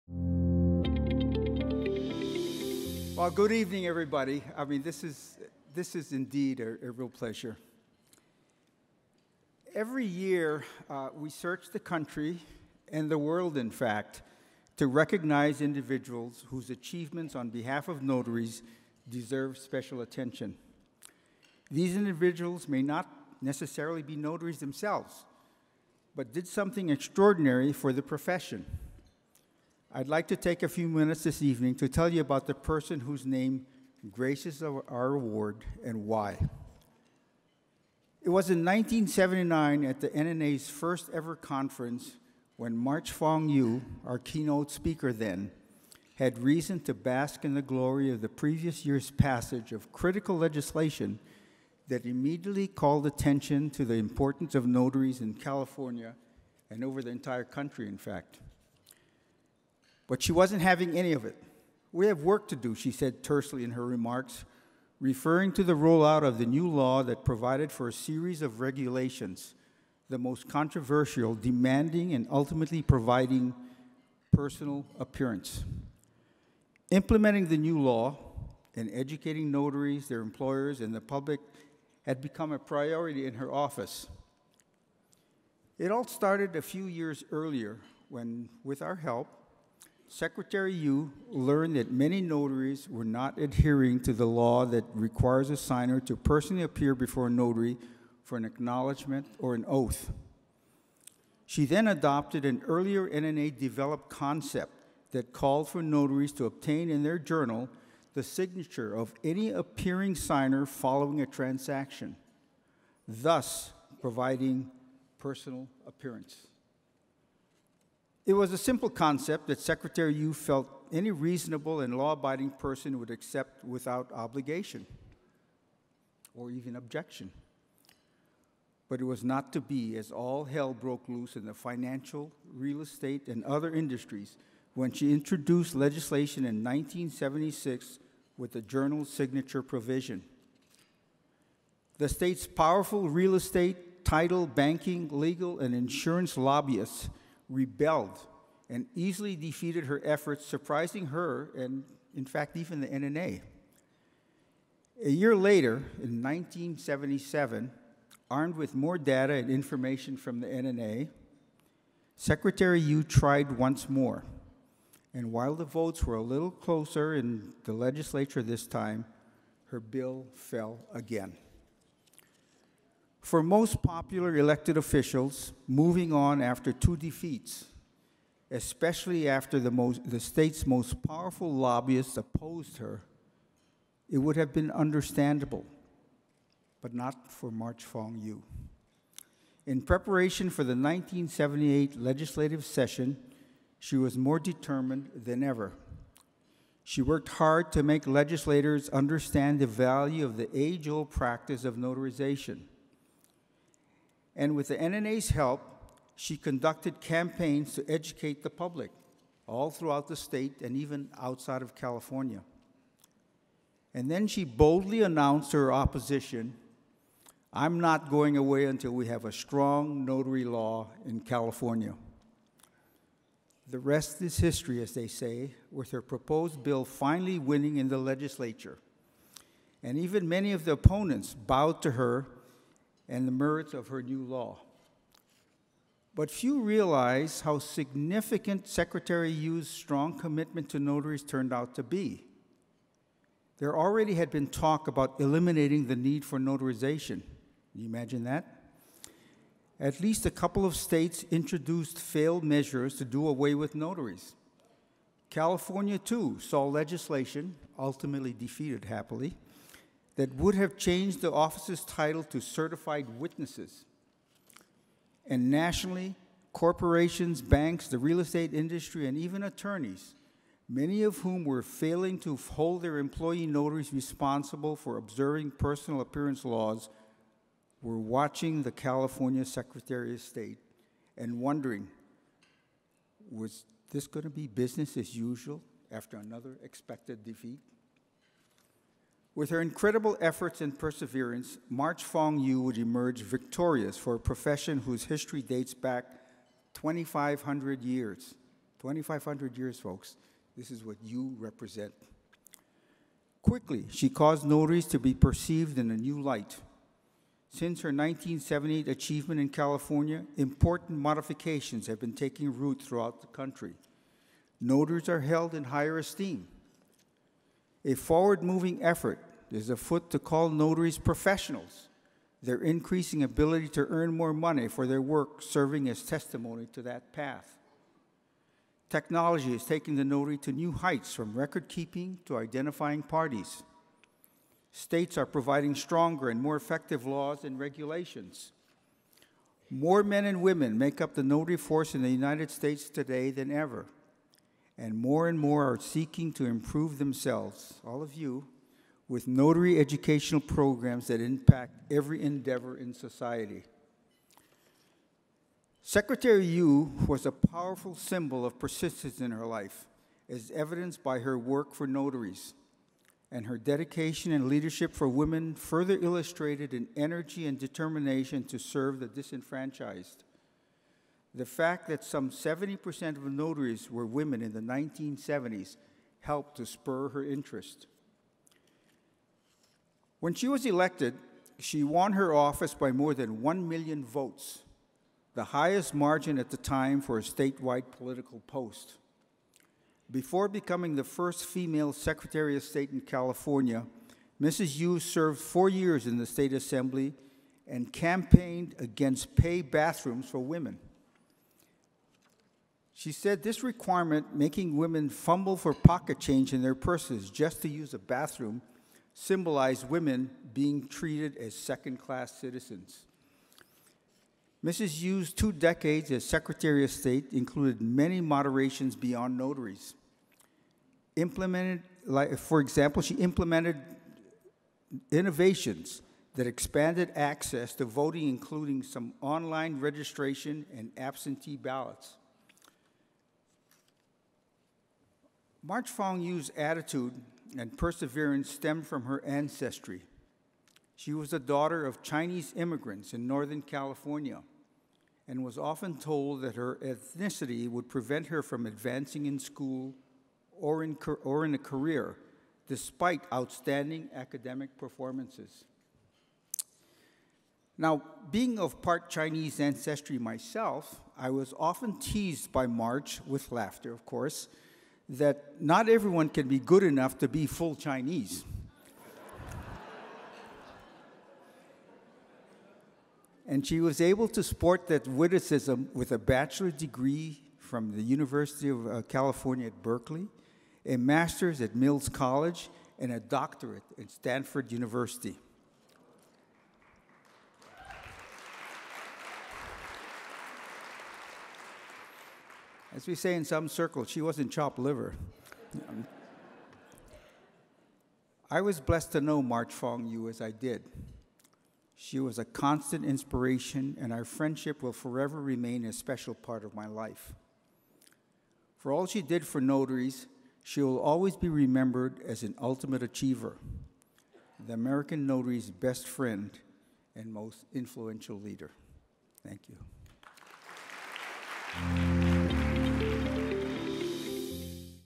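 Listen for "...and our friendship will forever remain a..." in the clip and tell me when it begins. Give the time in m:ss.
8:24.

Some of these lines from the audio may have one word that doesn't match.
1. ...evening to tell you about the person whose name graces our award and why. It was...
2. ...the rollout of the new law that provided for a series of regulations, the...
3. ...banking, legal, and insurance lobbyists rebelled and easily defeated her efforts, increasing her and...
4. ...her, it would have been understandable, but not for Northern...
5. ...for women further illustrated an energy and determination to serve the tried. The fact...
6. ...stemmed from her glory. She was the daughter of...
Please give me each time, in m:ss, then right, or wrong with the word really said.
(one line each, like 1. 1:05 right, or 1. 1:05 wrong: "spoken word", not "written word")
1. 0:31 right
2. 1:05 right
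3. 2:24 wrong: "surprising", not "increasing"
4. 3:02 wrong: "March", not "Northern"
5. 6:04 wrong: "disenfranchised", not "tried"
6. 7:18 wrong: "ancestry", not "glory".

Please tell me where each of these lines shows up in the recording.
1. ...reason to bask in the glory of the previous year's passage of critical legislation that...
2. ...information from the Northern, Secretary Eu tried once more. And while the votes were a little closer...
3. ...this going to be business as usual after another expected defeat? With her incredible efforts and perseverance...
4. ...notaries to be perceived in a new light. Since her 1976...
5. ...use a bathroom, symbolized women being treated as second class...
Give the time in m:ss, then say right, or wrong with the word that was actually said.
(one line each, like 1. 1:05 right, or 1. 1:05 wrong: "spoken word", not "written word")
1. 0:46 right
2. 2:39 wrong: "NNA", not "Northern"
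3. 4:43 right
4. 5:04 wrong: "1978", not "1976"
5. 6:47 right.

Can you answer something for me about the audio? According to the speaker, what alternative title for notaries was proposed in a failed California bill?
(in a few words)
certified witnesses.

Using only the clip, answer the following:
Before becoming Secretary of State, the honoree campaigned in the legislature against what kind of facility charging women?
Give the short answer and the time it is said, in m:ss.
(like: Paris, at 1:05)
pay bathrooms, at 6:39.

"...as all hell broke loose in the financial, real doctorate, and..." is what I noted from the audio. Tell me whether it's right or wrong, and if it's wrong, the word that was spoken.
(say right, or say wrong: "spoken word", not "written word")
wrong: "estate", not "doctorate".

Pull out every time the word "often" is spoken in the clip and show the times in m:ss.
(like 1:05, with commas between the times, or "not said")
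7:25, 7:41.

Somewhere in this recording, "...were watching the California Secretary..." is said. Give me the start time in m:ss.
4:37.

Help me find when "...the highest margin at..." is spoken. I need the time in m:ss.
6:25.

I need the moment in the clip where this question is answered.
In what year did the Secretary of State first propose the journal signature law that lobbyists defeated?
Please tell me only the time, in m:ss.
2:16.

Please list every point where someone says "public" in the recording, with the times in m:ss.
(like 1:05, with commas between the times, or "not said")
1:20, 3:28.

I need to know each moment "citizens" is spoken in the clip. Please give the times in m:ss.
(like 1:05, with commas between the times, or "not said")
6:52.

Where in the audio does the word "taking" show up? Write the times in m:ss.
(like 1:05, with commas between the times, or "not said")
5:12, 5:29.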